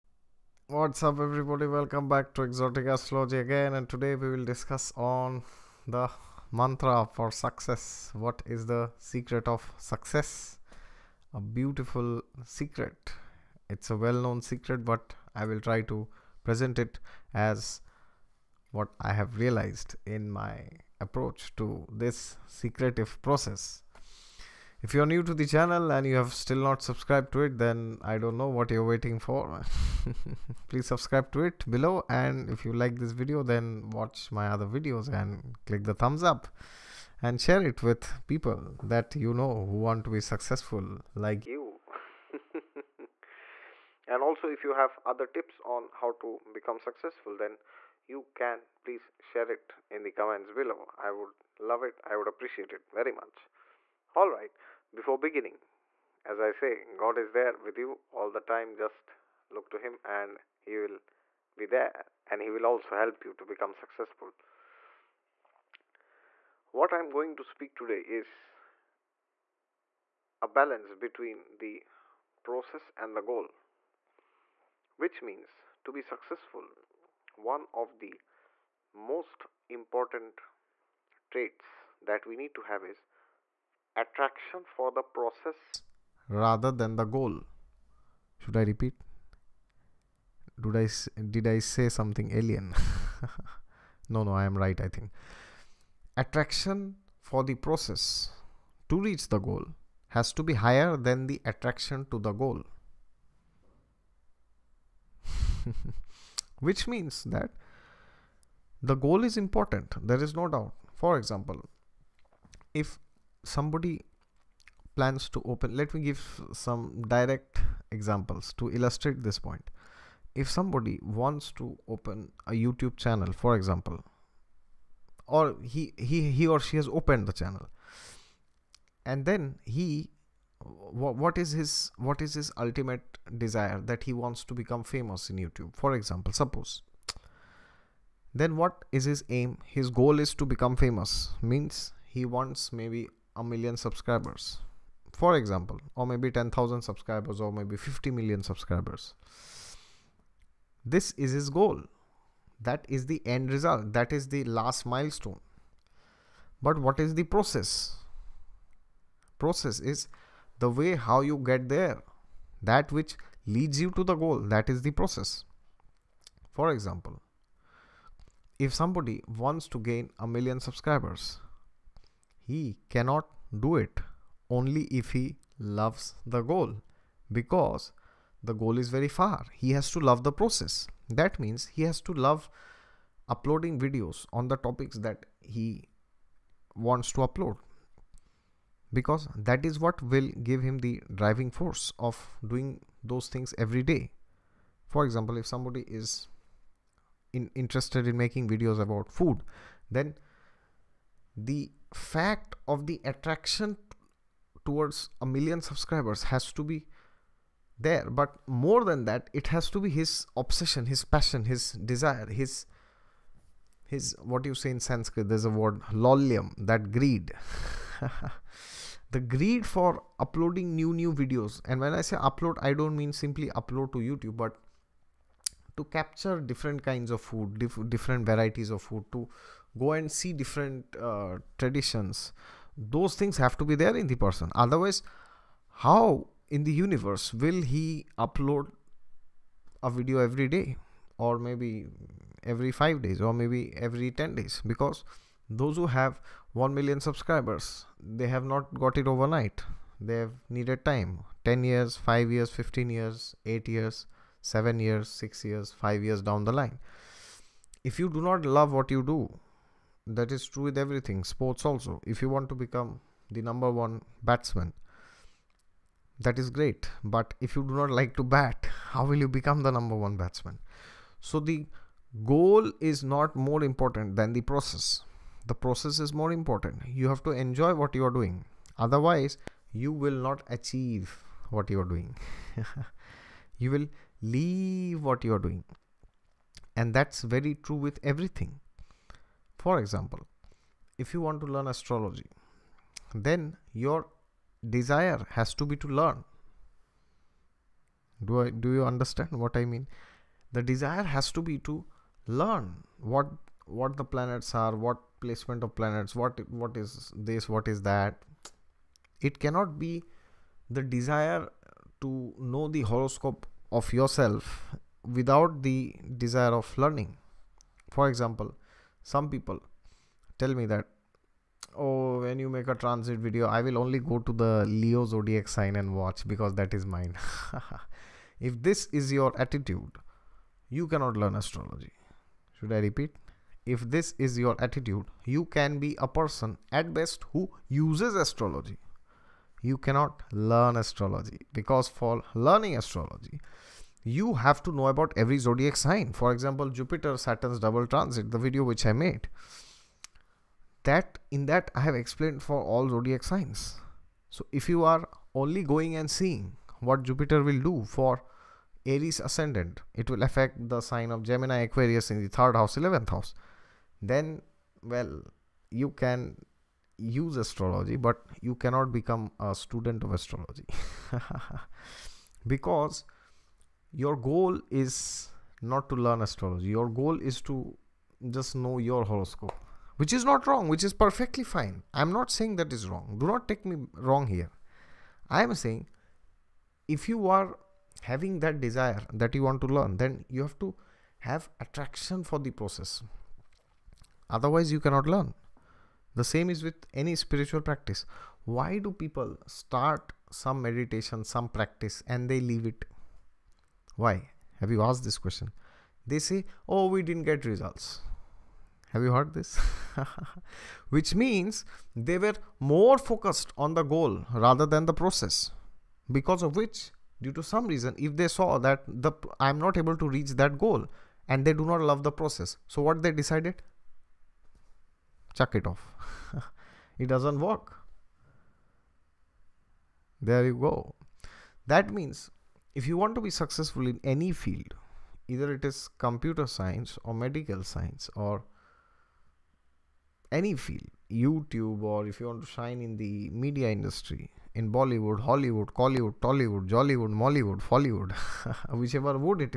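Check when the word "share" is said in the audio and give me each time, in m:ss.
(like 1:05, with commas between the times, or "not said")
0:37, 0:49.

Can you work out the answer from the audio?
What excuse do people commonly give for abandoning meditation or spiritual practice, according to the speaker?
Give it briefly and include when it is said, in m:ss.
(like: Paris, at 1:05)
We didn't get results, at 6:46.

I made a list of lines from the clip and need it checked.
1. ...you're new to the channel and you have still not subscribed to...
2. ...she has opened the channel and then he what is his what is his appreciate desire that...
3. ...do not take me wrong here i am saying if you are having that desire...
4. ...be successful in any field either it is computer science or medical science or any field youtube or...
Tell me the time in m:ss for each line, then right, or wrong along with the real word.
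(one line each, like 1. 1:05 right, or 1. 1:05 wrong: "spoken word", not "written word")
1. 0:24 right
2. 2:06 wrong: "ultimate", not "appreciate"
3. 6:23 right
4. 7:13 right.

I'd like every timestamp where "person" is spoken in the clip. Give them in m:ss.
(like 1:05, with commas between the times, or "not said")
3:54, 5:36.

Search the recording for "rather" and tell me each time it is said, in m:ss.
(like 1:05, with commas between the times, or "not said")
1:26, 6:54.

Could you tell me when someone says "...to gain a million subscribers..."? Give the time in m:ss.
2:49.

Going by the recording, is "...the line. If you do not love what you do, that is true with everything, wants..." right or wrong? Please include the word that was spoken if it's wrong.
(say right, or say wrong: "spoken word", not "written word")
wrong: "sports", not "wants".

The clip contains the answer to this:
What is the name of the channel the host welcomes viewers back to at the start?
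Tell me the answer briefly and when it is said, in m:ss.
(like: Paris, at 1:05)
Exotic Astrology, at 0:02.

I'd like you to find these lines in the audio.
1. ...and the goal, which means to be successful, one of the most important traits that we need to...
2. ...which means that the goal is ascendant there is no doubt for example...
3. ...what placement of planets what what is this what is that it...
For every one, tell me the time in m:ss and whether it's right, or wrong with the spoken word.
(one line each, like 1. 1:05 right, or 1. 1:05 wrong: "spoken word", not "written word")
1. 1:12 right
2. 1:46 wrong: "important", not "ascendant"
3. 5:04 right.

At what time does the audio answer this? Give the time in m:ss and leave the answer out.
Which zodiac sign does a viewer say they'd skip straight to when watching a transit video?
5:24.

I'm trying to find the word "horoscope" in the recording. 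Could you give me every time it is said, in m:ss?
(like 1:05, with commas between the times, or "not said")
5:12, 6:19.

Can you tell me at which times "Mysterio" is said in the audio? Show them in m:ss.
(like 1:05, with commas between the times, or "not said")
not said.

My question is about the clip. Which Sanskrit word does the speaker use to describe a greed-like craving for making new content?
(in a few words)
laulyam.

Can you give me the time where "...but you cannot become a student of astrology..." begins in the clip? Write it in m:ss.
6:07.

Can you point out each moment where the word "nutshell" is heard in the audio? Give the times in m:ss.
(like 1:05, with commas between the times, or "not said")
not said.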